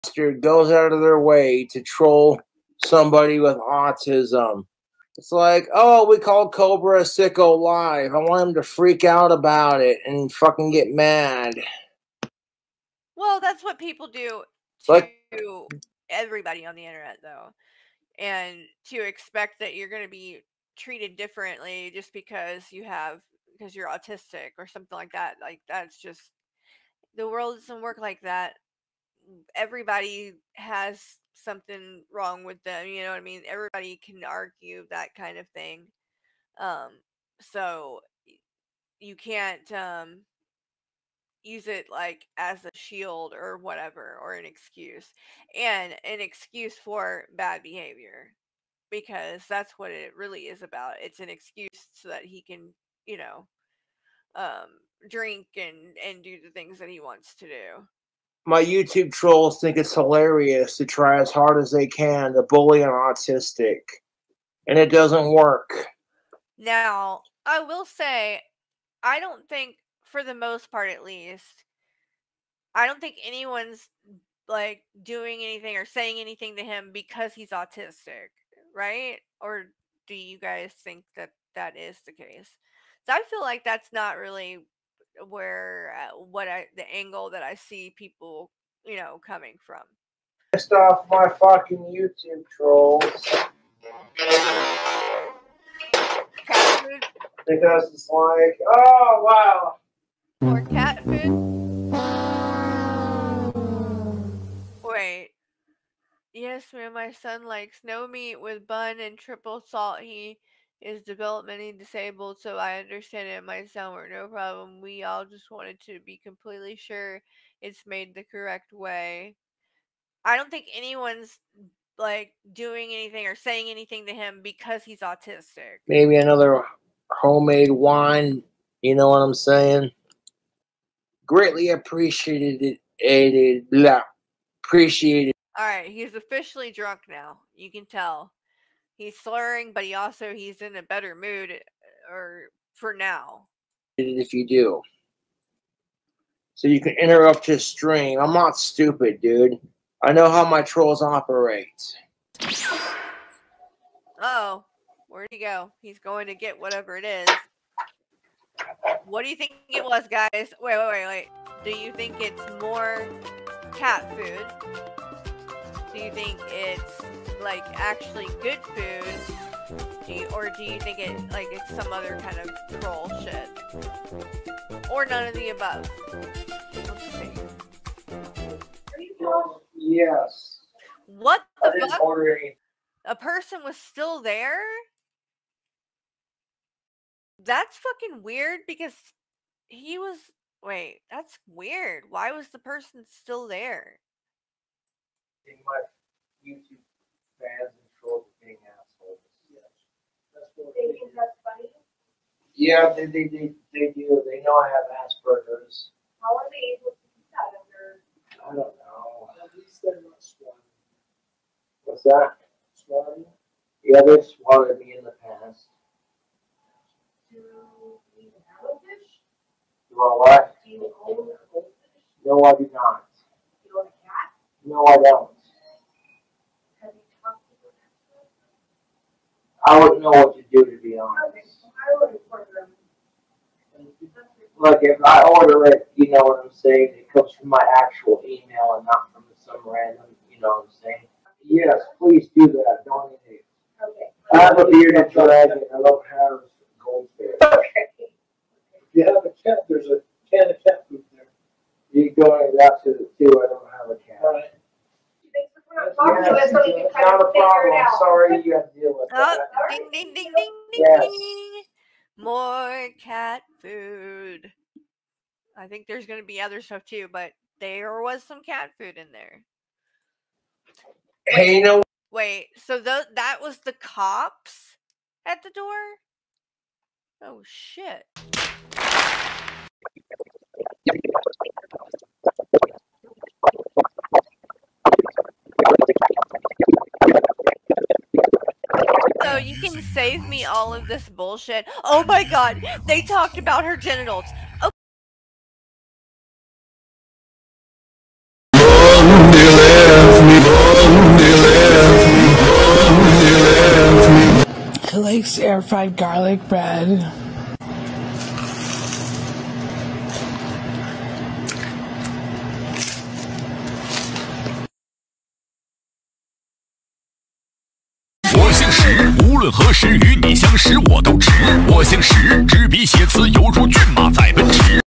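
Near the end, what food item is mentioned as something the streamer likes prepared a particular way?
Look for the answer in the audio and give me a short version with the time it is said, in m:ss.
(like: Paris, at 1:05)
air fried garlic bread, at 5:05.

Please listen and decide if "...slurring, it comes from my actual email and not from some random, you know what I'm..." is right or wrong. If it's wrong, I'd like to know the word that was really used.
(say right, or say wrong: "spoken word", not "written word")
wrong: "saying", not "slurring".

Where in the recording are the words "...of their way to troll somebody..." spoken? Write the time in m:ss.
0:00.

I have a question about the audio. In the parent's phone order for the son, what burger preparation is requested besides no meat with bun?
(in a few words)
triple salt.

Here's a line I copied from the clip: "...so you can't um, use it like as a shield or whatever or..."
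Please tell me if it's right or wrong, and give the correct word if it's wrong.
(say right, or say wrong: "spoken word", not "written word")
right.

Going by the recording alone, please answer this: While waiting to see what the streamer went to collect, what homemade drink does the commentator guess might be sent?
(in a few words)
homemade wine.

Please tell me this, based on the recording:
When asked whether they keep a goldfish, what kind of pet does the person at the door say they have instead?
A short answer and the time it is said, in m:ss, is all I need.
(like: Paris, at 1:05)
bearded dragon, at 4:04.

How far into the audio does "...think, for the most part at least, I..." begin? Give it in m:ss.
1:09.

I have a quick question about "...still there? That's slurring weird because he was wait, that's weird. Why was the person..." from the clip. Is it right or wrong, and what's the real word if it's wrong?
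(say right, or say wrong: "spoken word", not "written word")
wrong: "fucking", not "slurring".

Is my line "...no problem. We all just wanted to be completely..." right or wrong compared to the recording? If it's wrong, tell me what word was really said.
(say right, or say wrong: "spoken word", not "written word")
right.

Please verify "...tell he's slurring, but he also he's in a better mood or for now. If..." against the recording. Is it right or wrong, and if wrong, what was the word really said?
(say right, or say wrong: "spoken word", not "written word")
right.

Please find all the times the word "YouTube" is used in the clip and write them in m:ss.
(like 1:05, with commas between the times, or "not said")
0:58, 1:31, 3:16.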